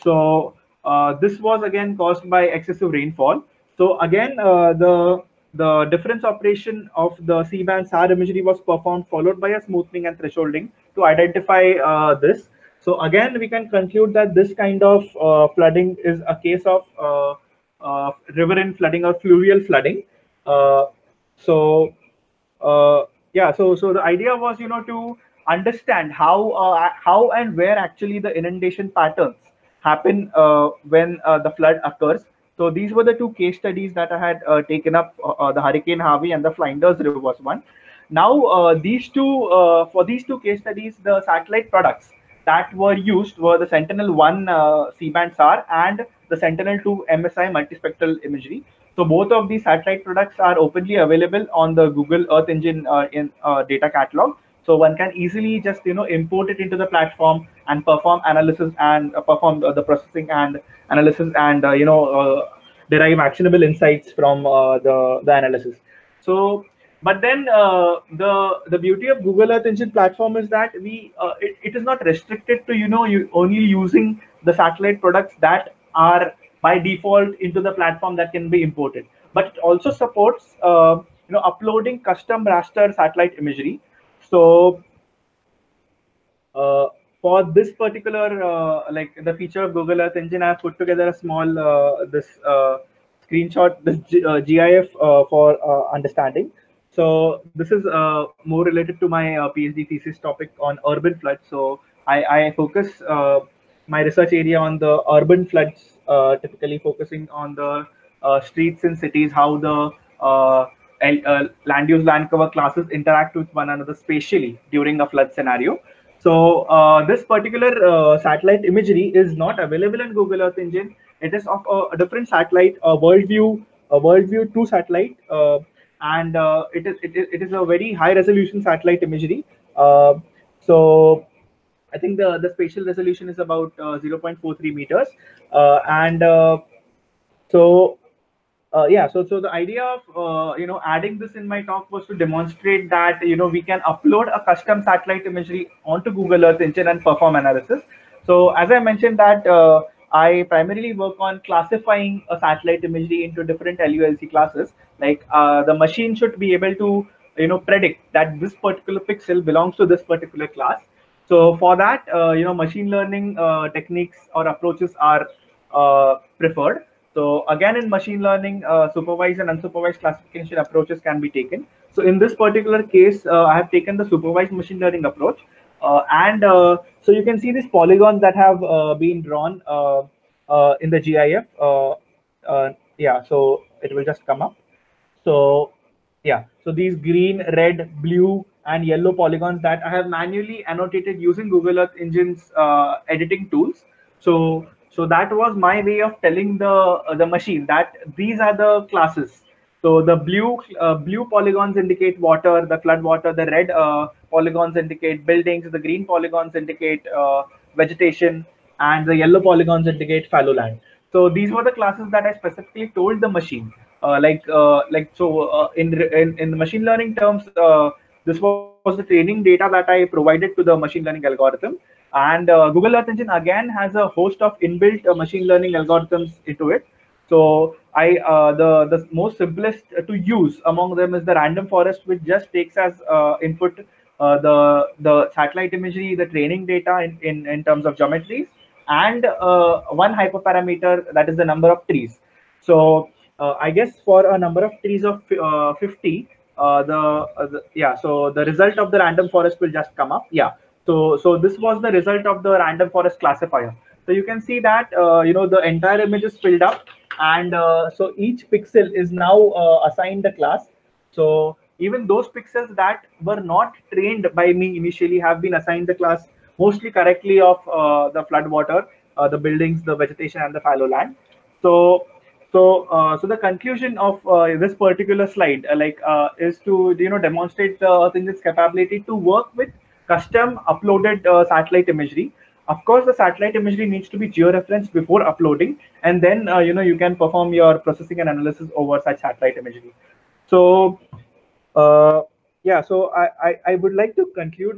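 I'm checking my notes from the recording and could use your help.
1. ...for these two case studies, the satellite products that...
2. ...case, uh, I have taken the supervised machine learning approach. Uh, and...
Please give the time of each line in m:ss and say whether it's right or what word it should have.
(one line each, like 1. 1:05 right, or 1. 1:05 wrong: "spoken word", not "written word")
1. 0:39 right
2. 2:52 right.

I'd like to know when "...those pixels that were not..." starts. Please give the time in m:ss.
4:22.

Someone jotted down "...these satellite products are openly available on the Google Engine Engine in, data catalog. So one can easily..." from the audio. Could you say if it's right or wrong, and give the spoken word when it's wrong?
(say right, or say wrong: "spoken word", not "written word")
wrong: "Earth", not "Engine".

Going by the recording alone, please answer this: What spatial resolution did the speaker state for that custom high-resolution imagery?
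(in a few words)
0.43 meters.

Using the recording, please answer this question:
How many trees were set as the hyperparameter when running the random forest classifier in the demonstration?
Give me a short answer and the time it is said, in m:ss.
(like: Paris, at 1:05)
50, at 4:05.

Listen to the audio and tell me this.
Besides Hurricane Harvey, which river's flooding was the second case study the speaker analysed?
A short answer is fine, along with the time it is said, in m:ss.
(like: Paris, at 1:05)
Flinders River, at 0:36.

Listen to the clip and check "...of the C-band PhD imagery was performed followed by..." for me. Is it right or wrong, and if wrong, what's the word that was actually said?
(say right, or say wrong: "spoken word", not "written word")
wrong: "SAR", not "PhD".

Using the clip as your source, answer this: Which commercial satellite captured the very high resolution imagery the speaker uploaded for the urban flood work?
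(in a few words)
WorldView 2.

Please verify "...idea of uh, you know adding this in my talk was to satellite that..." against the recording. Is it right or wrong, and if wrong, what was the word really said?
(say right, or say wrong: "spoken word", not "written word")
wrong: "demonstrate", not "satellite".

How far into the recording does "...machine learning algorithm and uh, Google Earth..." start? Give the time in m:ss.
3:40.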